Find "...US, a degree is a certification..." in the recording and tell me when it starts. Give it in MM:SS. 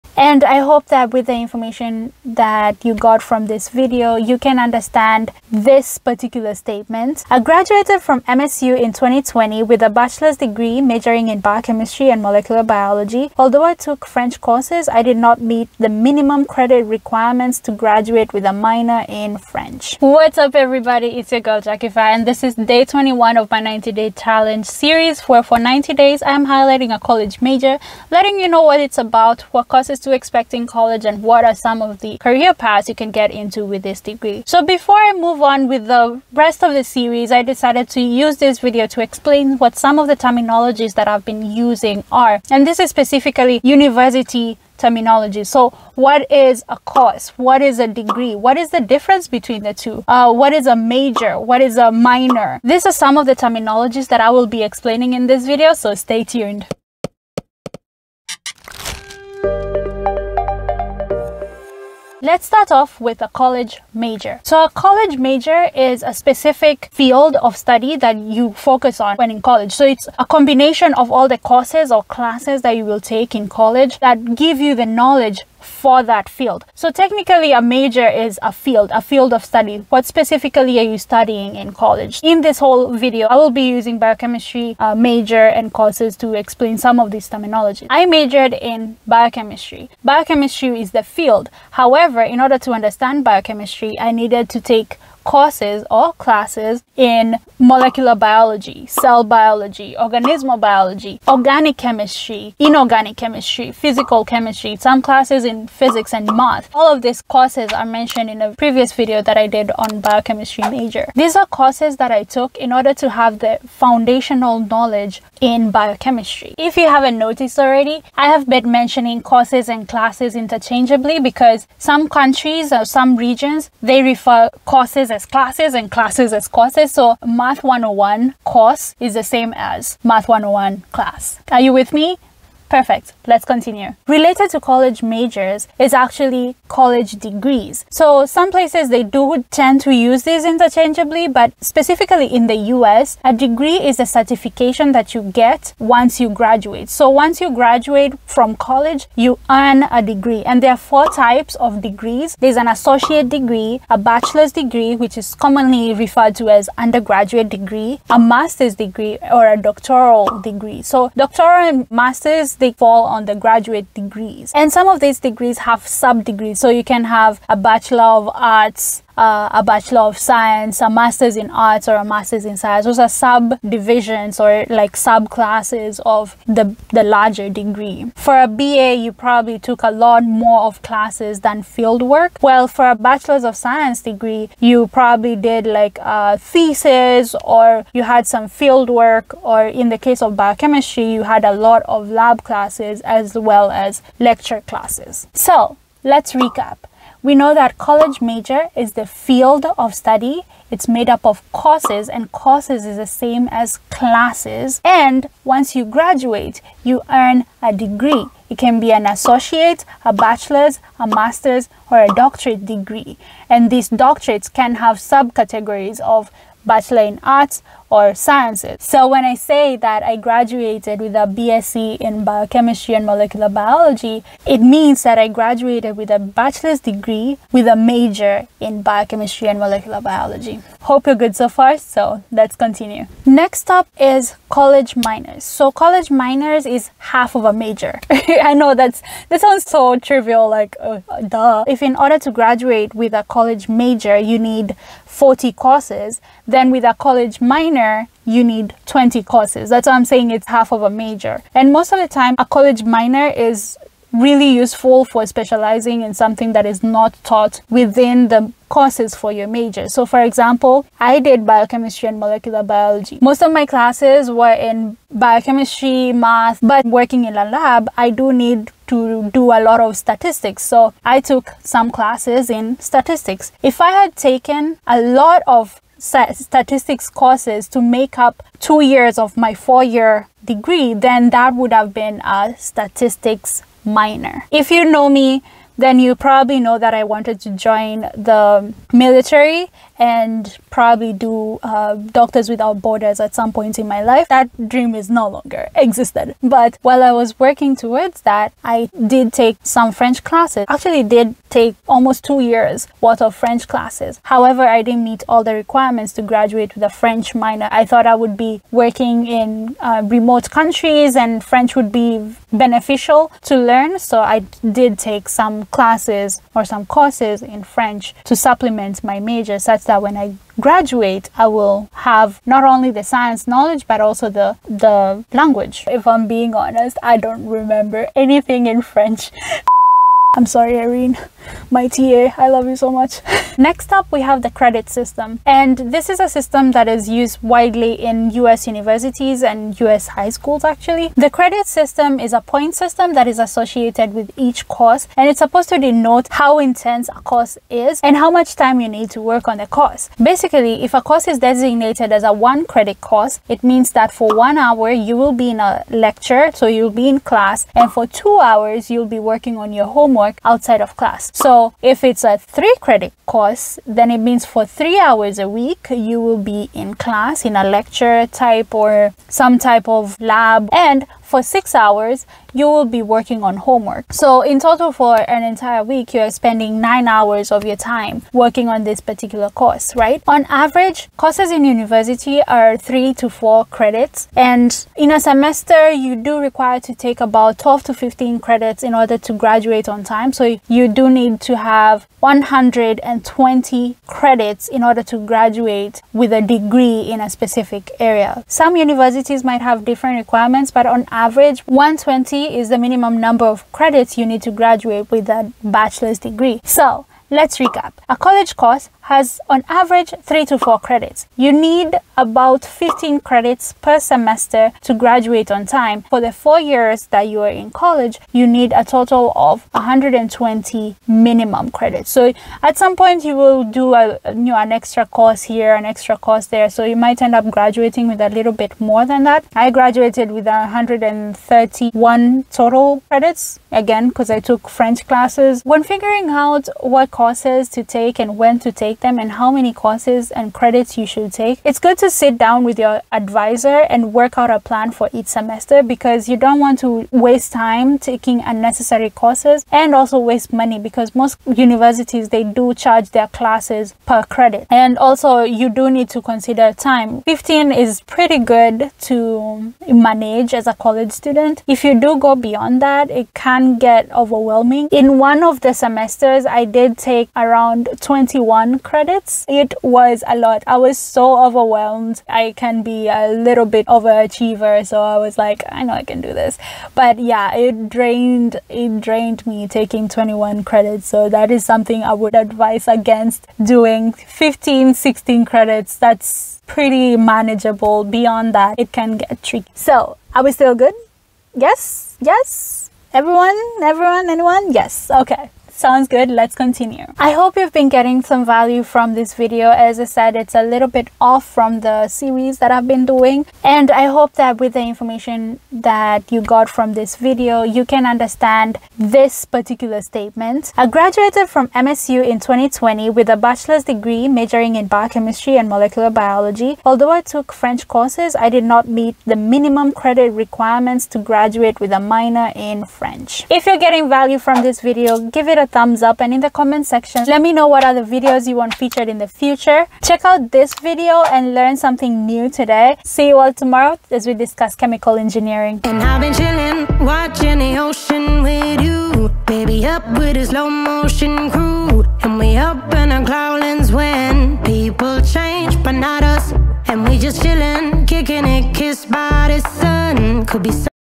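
02:22.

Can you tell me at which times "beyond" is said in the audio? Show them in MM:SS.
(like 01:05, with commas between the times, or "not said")
07:42, 08:08.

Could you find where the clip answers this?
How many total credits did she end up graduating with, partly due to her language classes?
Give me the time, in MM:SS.
07:10.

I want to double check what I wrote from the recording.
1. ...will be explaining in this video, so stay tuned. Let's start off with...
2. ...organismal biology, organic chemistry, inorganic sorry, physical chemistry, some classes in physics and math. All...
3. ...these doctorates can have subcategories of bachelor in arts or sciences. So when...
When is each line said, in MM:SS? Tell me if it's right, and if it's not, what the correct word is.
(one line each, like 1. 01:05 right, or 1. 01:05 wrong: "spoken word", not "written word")
1. 00:54 right
2. 01:39 wrong: "chemistry", not "sorry"
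3. 03:33 right.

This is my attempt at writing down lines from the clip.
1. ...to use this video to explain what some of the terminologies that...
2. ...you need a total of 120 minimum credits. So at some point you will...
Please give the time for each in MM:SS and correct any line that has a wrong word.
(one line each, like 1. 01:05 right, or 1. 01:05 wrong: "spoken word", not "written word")
1. 00:37 right
2. 06:58 right.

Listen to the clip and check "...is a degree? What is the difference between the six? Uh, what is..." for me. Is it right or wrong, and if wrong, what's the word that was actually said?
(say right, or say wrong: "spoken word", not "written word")
wrong: "two", not "six".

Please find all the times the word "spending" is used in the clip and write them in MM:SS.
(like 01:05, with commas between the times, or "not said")
06:16.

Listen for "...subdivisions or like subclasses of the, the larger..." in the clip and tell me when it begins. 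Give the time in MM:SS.
02:53.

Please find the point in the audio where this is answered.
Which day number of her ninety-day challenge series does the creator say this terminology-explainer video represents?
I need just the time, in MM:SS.
00:22.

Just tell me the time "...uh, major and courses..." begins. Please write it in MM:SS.
01:24.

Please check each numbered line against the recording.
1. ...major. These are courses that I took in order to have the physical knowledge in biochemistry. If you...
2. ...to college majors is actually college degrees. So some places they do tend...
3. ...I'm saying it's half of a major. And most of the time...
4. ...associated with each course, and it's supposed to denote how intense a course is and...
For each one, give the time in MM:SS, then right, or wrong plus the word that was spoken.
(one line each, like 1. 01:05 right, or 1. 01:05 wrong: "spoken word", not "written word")
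1. 01:50 wrong: "foundational", not "physical"
2. 02:14 right
3. 04:09 right
4. 05:43 right.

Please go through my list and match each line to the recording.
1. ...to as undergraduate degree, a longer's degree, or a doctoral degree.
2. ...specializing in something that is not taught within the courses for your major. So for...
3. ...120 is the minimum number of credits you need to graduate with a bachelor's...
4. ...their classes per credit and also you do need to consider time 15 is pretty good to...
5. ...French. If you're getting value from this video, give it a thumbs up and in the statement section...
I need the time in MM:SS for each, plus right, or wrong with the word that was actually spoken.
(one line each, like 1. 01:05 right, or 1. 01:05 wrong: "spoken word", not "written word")
1. 02:36 wrong: "master", not "longer"
2. 04:15 right
3. 06:41 right
4. 07:33 right
5. 08:42 wrong: "comment", not "statement".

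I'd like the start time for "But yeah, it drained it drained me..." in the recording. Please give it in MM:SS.
07:56.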